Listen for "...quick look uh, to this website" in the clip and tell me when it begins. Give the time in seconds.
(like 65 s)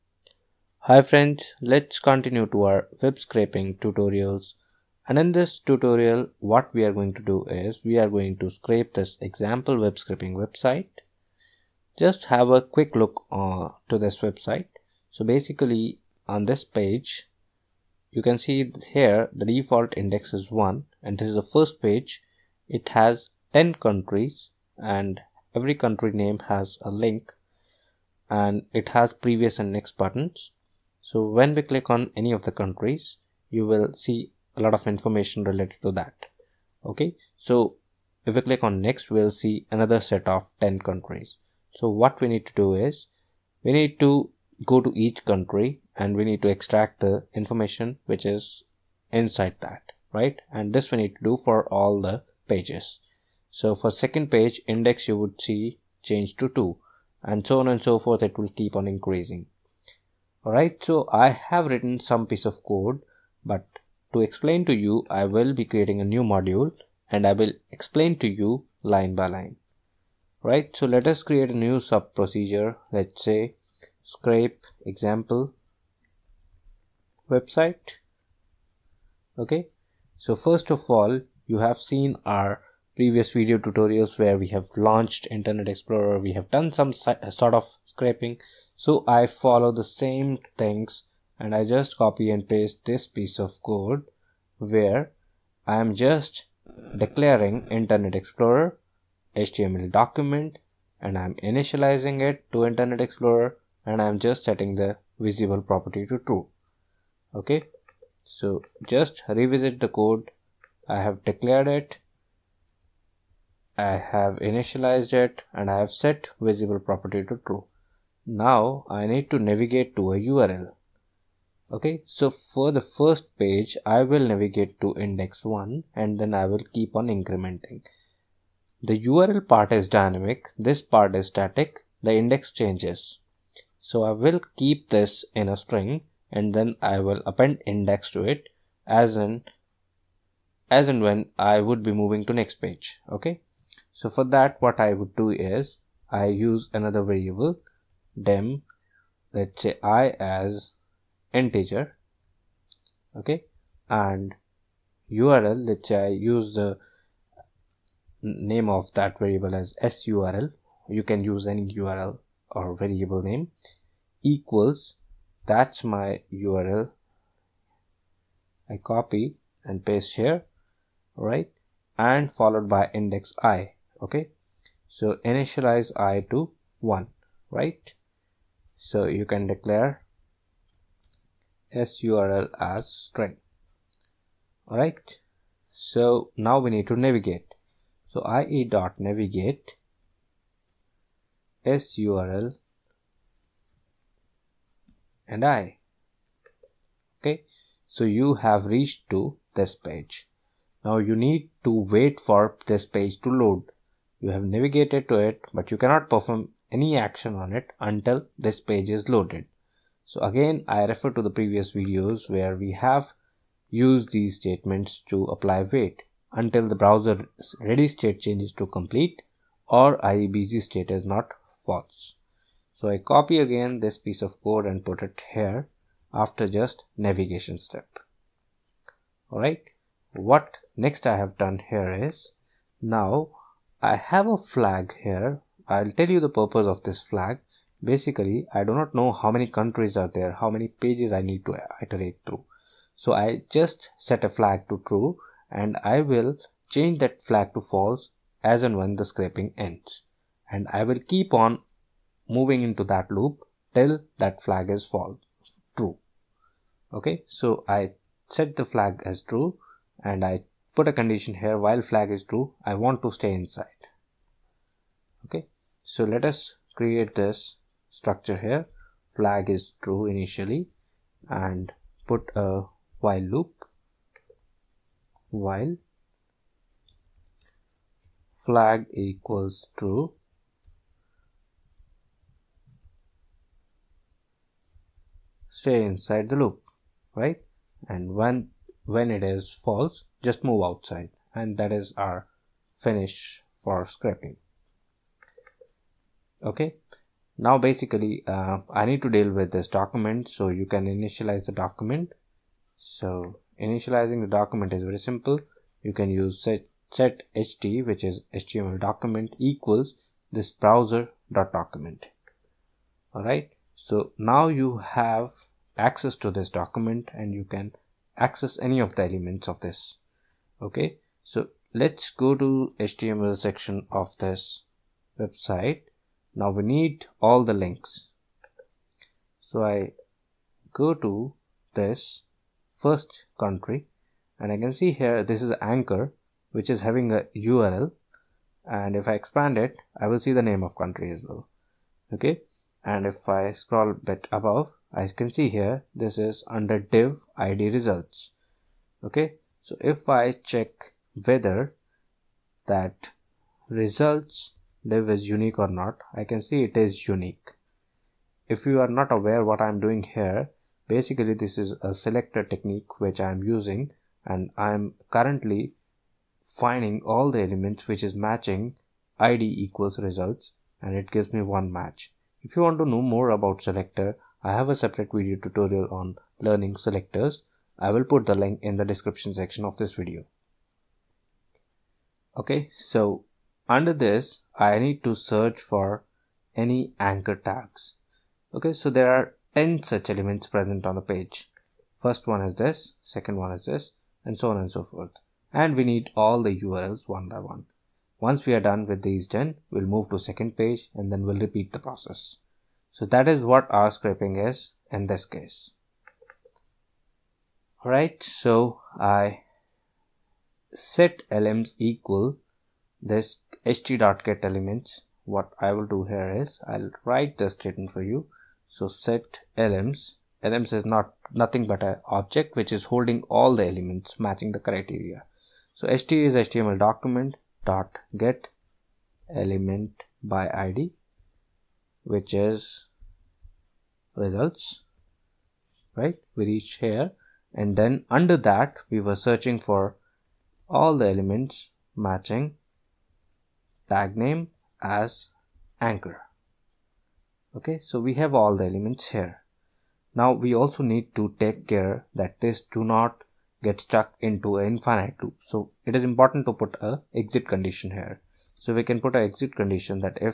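12 s.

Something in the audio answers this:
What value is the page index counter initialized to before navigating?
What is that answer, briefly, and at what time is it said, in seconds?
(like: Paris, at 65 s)
1, at 175 s.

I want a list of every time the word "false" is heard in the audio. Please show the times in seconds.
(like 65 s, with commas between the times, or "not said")
221 s, 247 s, 254 s, 289 s.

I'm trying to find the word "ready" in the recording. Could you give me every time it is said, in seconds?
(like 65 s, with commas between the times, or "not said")
217 s.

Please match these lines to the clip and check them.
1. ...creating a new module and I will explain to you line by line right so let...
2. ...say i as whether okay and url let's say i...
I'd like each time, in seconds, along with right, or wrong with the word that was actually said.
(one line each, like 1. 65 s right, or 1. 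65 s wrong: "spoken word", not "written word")
1. 65 s right
2. 149 s wrong: "integer", not "whether".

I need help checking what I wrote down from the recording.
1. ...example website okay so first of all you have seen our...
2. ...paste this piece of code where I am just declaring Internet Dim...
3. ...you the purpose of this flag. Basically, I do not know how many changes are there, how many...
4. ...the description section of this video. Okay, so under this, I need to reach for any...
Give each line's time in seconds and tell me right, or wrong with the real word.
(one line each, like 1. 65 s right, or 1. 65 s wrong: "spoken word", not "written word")
1. 74 s right
2. 92 s wrong: "Explorer", not "Dim"
3. 236 s wrong: "countries", not "changes"
4. 378 s wrong: "search", not "reach".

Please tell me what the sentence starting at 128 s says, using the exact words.
The URL part is dynamic, this part is static, the index changes.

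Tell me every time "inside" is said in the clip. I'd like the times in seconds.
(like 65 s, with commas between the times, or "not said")
49 s, 263 s, 285 s.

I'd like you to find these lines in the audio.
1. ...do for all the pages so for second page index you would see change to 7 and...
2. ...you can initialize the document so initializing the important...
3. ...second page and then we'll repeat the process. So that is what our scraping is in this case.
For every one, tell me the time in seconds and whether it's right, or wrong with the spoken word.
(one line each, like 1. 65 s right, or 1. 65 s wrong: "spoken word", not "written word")
1. 51 s wrong: "2", not "7"
2. 300 s wrong: "document", not "important"
3. 400 s right.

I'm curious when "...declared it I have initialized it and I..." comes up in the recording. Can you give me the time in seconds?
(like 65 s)
111 s.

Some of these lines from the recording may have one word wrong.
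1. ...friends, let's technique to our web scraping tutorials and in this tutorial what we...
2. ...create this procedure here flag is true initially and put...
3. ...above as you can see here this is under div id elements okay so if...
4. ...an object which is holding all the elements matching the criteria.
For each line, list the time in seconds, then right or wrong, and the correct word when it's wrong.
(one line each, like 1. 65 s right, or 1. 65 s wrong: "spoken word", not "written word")
1. 1 s wrong: "continue", not "technique"
2. 266 s wrong: "structure", not "procedure"
3. 344 s wrong: "results", not "elements"
4. 421 s right.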